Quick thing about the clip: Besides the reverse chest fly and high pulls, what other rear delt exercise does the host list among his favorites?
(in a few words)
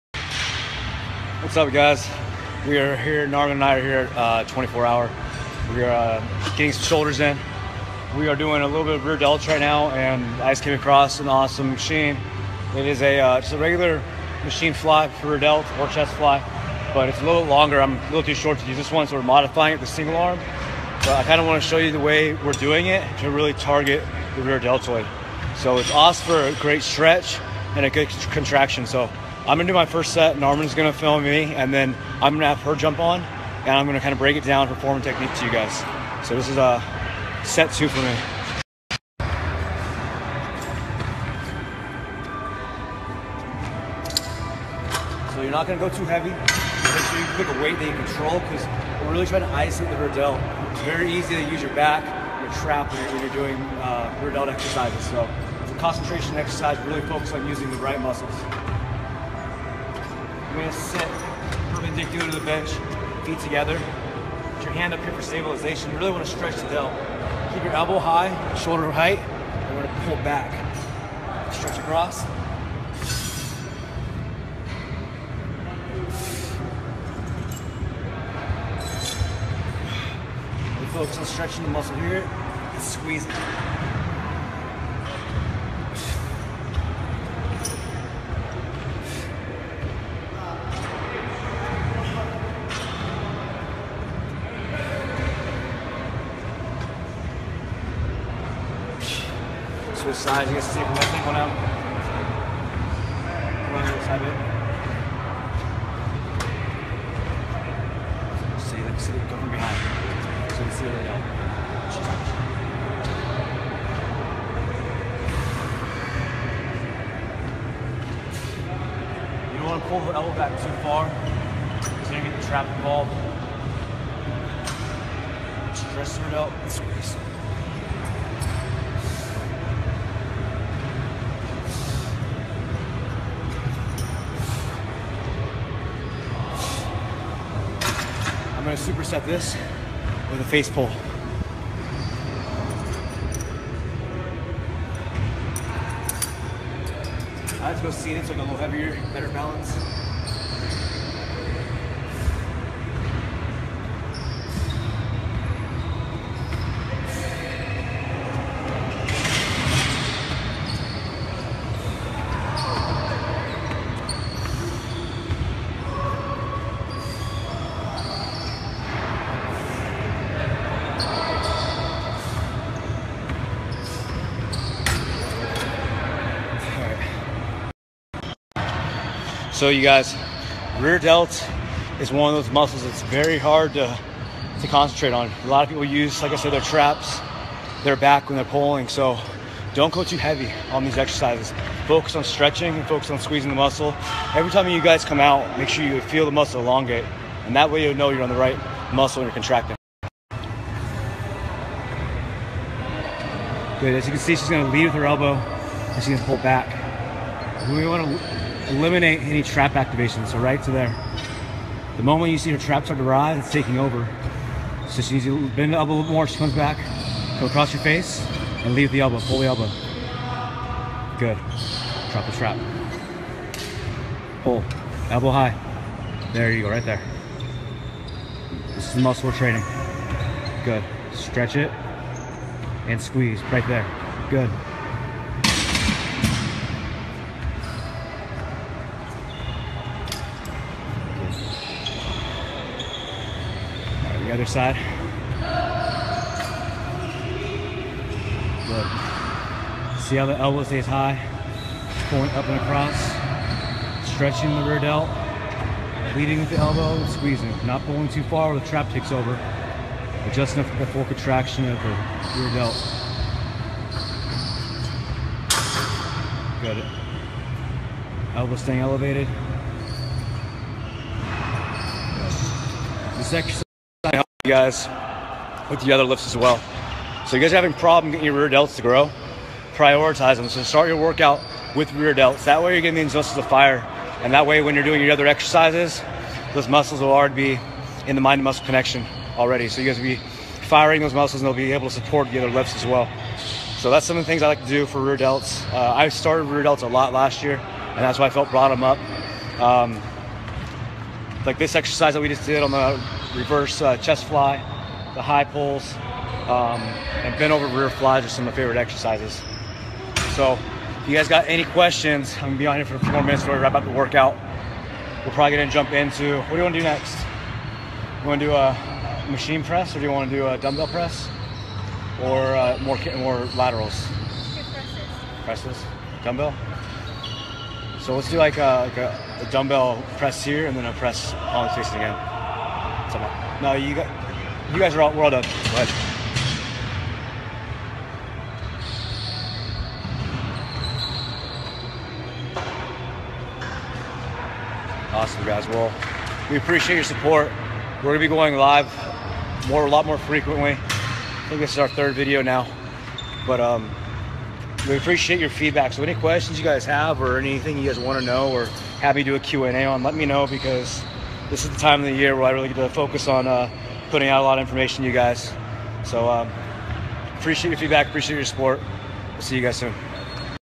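Bent over rear flies.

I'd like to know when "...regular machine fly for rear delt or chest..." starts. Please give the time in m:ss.
0:13.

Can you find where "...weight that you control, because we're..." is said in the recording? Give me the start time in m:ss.
0:47.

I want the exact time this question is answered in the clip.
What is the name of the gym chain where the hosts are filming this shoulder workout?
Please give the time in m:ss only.
0:04.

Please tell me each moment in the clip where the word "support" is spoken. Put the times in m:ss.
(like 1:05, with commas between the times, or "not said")
4:51, 5:47, 6:08.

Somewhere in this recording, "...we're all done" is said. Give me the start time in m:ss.
5:35.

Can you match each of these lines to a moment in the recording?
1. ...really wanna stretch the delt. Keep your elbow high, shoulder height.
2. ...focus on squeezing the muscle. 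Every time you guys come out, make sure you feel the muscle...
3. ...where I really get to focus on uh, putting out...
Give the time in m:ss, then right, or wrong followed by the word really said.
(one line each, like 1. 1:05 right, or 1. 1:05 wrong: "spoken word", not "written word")
1. 1:05 right
2. 3:12 right
3. 6:02 right.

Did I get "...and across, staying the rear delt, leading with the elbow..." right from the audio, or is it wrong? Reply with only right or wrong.
wrong.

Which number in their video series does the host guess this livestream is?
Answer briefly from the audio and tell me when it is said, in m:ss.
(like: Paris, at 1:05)
Third, at 5:51.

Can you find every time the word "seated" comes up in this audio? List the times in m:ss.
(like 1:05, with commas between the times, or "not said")
2:27.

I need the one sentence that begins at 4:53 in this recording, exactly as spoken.
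So that's some of the things I like to do for rear delts.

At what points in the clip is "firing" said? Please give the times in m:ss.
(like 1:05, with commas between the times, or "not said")
4:50.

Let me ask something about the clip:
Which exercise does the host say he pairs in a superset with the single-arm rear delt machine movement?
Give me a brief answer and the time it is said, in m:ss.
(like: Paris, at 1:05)
Face pull, at 2:20.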